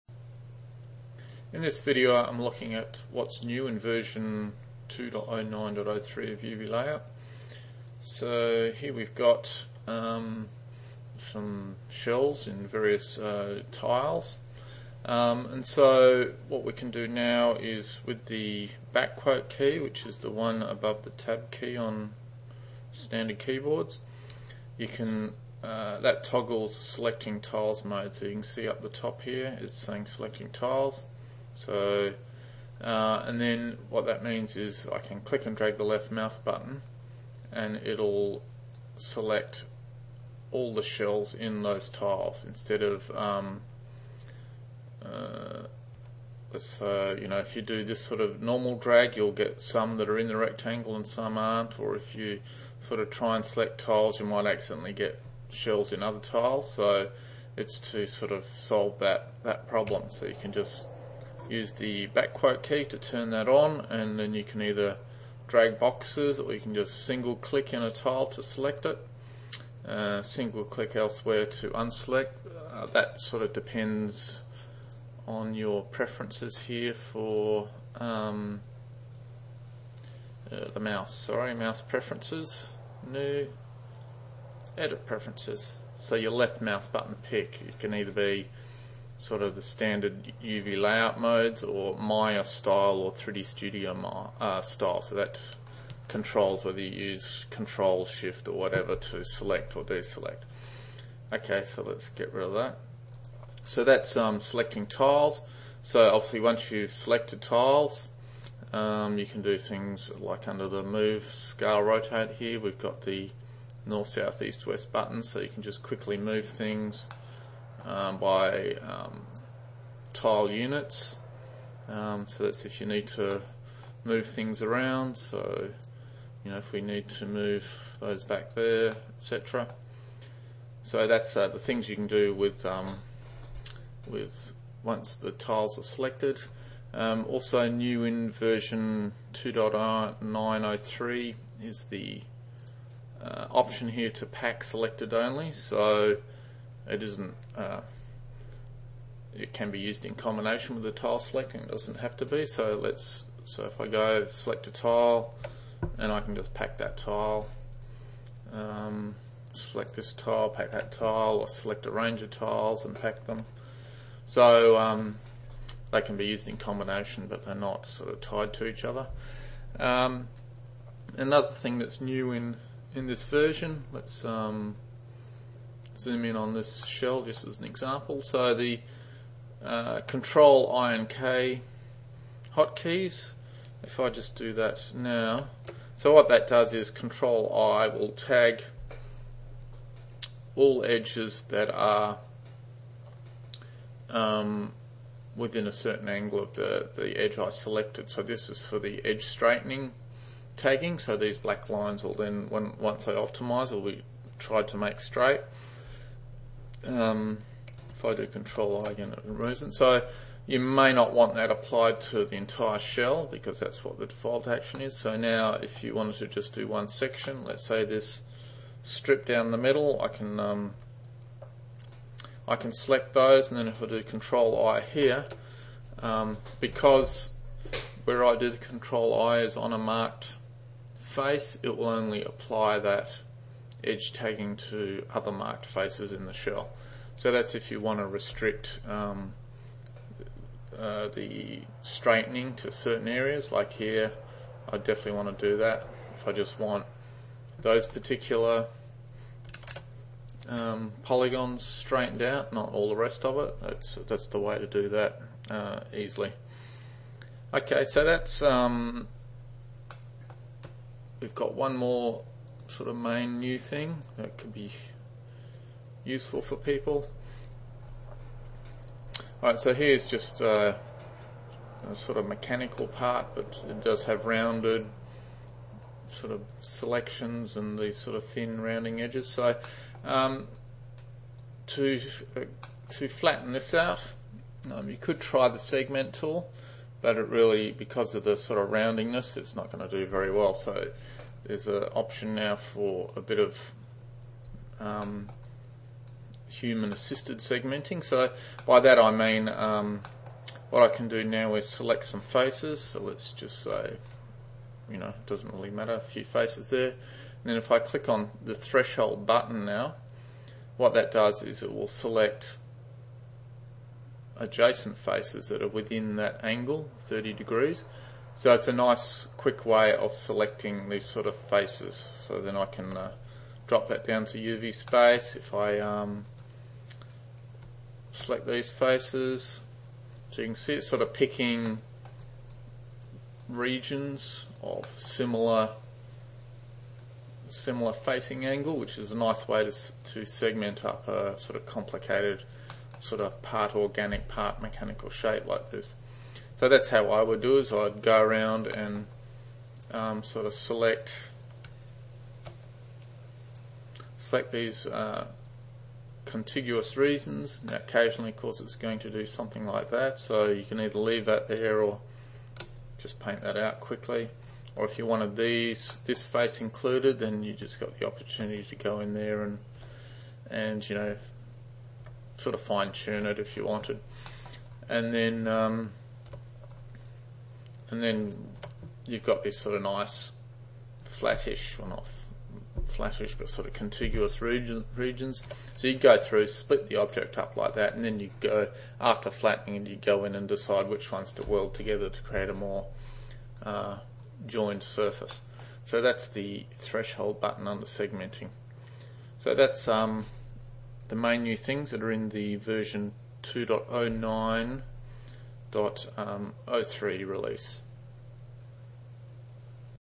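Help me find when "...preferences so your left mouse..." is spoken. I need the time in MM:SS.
01:25.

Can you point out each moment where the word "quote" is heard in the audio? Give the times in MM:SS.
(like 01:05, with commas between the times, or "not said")
00:19, 01:02.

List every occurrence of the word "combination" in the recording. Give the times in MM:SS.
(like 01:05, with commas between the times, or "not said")
02:30, 02:46.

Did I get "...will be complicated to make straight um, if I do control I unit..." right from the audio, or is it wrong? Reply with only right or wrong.
wrong.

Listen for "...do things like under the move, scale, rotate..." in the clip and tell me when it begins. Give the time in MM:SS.
01:49.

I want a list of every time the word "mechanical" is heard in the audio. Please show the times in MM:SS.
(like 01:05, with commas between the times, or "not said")
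04:32, 05:44.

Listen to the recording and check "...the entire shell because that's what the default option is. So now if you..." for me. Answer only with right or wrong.
wrong.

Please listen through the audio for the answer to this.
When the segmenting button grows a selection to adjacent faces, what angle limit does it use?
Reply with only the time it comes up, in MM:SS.
05:16.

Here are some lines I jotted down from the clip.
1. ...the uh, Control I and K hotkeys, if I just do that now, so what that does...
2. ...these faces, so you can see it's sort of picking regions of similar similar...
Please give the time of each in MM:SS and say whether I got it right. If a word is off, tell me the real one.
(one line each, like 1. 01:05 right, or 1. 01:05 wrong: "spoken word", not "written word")
1. 02:58 right
2. 05:28 right.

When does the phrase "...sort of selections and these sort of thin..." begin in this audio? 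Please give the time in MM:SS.
04:36.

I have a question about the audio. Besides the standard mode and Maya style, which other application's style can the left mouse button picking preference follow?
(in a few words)
3D Studio.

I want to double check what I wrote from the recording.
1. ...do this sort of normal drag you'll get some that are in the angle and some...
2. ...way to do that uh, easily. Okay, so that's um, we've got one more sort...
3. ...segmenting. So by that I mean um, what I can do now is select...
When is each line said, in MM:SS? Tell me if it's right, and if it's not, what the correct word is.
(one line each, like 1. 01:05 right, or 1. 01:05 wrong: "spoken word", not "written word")
1. 00:47 wrong: "rectangle", not "angle"
2. 04:14 right
3. 04:57 right.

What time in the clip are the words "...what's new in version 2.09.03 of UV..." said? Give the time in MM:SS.
00:03.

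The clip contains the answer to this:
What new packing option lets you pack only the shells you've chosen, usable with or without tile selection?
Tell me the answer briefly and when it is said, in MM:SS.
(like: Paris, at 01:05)
pack selected only, at 02:24.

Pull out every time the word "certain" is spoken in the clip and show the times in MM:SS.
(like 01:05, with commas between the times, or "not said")
03:15, 04:02.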